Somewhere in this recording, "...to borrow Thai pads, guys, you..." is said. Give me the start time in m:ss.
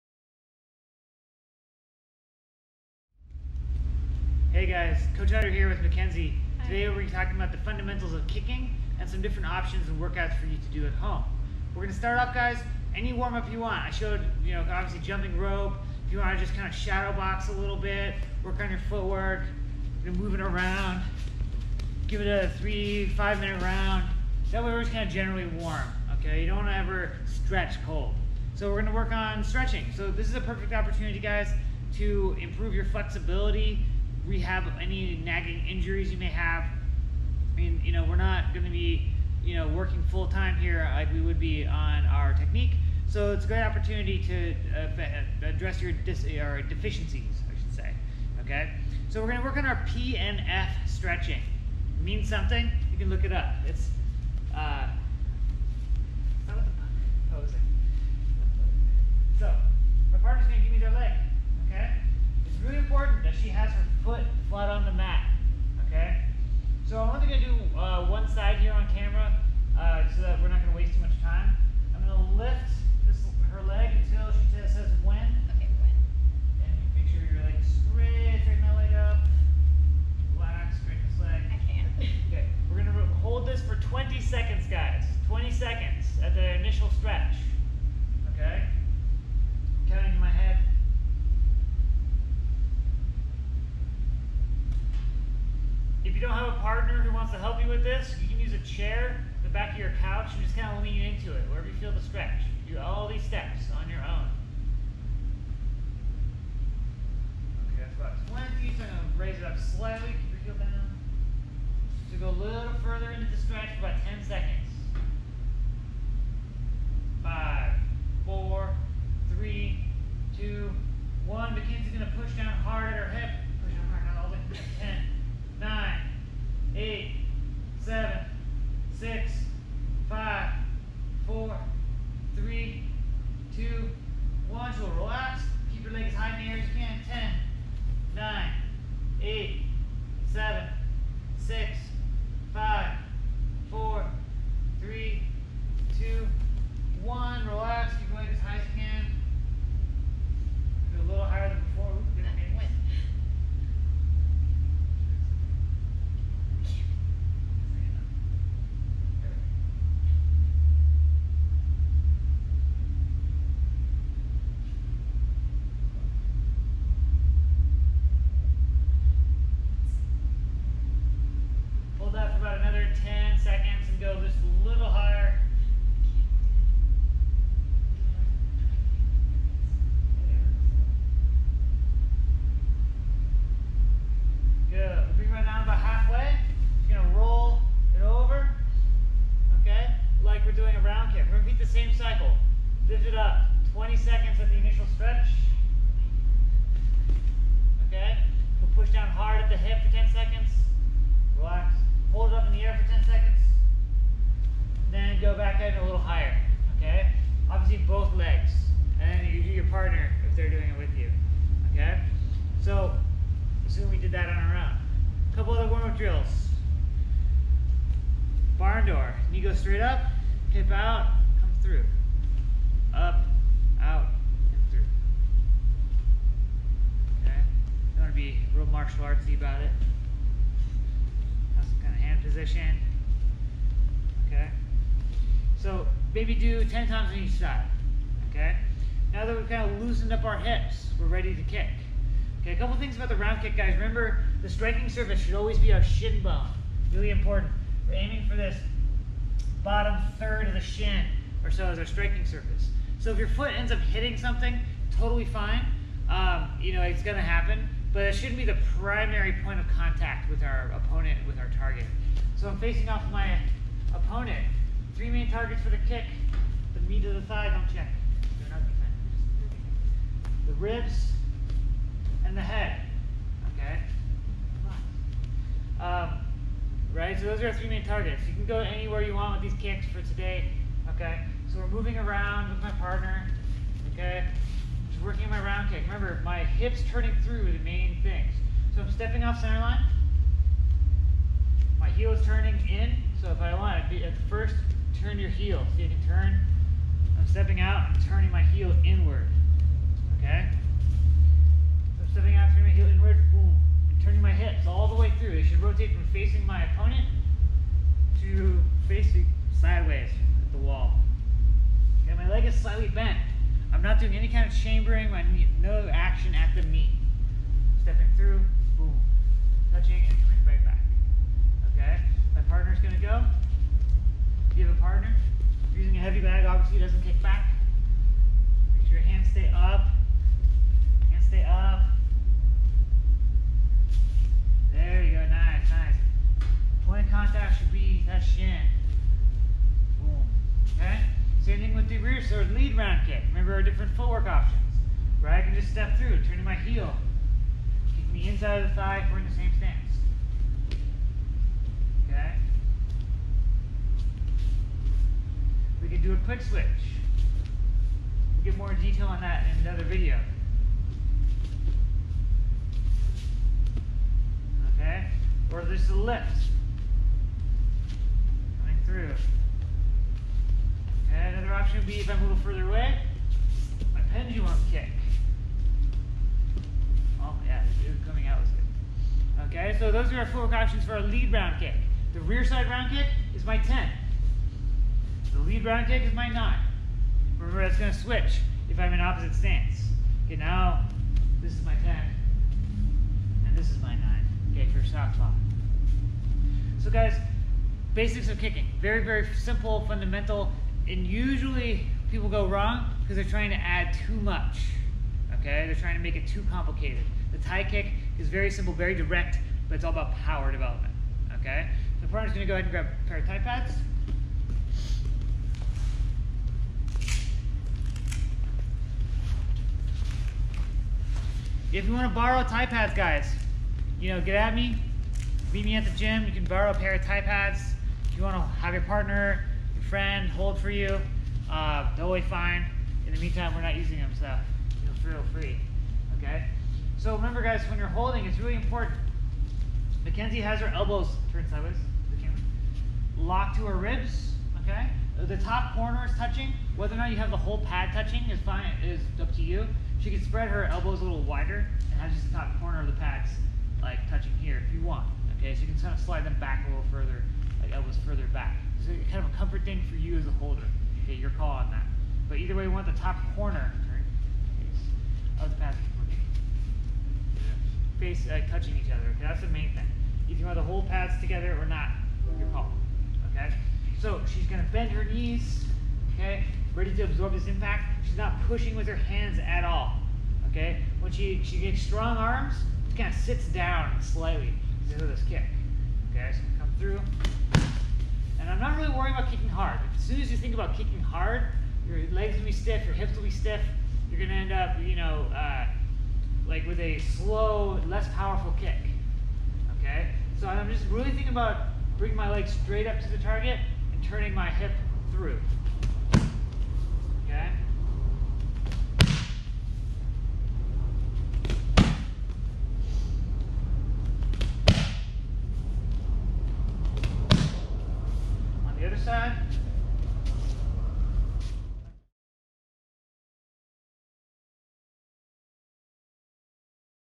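7:02.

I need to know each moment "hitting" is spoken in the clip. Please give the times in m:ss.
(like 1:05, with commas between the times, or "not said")
4:13.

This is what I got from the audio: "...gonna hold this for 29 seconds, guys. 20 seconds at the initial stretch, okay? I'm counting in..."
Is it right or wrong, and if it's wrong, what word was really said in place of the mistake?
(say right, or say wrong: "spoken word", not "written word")
wrong: "20", not "29".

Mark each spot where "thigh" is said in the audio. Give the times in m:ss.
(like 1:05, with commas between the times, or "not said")
4:27, 5:48.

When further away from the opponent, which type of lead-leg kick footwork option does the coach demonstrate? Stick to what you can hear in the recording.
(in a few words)
Pendulum kick.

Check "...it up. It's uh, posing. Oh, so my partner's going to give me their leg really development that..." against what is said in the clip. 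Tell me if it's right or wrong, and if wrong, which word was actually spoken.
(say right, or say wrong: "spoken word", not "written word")
wrong: "important", not "development".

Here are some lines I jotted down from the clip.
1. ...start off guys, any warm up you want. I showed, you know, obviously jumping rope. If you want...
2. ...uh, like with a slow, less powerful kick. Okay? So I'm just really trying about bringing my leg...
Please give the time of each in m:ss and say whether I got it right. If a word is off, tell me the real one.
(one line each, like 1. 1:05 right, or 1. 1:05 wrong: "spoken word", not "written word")
1. 0:11 right
2. 8:15 wrong: "thinking", not "trying".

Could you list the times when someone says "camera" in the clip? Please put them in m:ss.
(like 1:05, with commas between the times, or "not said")
1:08, 7:22.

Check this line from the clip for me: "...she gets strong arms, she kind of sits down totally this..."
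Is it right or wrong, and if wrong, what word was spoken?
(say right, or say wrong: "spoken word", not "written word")
wrong: "slightly", not "totally".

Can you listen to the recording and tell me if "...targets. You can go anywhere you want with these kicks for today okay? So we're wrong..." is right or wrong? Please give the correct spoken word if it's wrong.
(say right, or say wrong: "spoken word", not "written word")
wrong: "moving", not "wrong".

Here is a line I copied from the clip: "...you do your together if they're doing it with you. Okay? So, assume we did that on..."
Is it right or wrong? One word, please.
wrong.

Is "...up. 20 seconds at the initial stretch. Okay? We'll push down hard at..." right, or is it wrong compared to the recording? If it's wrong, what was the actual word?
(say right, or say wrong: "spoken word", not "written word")
right.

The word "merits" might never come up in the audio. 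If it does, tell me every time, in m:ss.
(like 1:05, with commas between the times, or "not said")
not said.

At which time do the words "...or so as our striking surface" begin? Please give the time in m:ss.
4:11.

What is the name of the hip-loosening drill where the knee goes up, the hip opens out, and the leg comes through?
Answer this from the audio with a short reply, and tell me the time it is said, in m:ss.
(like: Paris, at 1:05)
Barn door, at 3:38.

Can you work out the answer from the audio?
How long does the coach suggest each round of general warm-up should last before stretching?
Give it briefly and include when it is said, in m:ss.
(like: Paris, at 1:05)
3 to 5 minutes, at 0:22.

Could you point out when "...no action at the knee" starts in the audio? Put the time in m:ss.
5:15.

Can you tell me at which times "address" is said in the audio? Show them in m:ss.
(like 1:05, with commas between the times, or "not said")
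0:45.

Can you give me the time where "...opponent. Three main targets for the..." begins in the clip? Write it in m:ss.
4:23.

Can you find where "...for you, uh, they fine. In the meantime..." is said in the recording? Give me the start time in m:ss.
7:10.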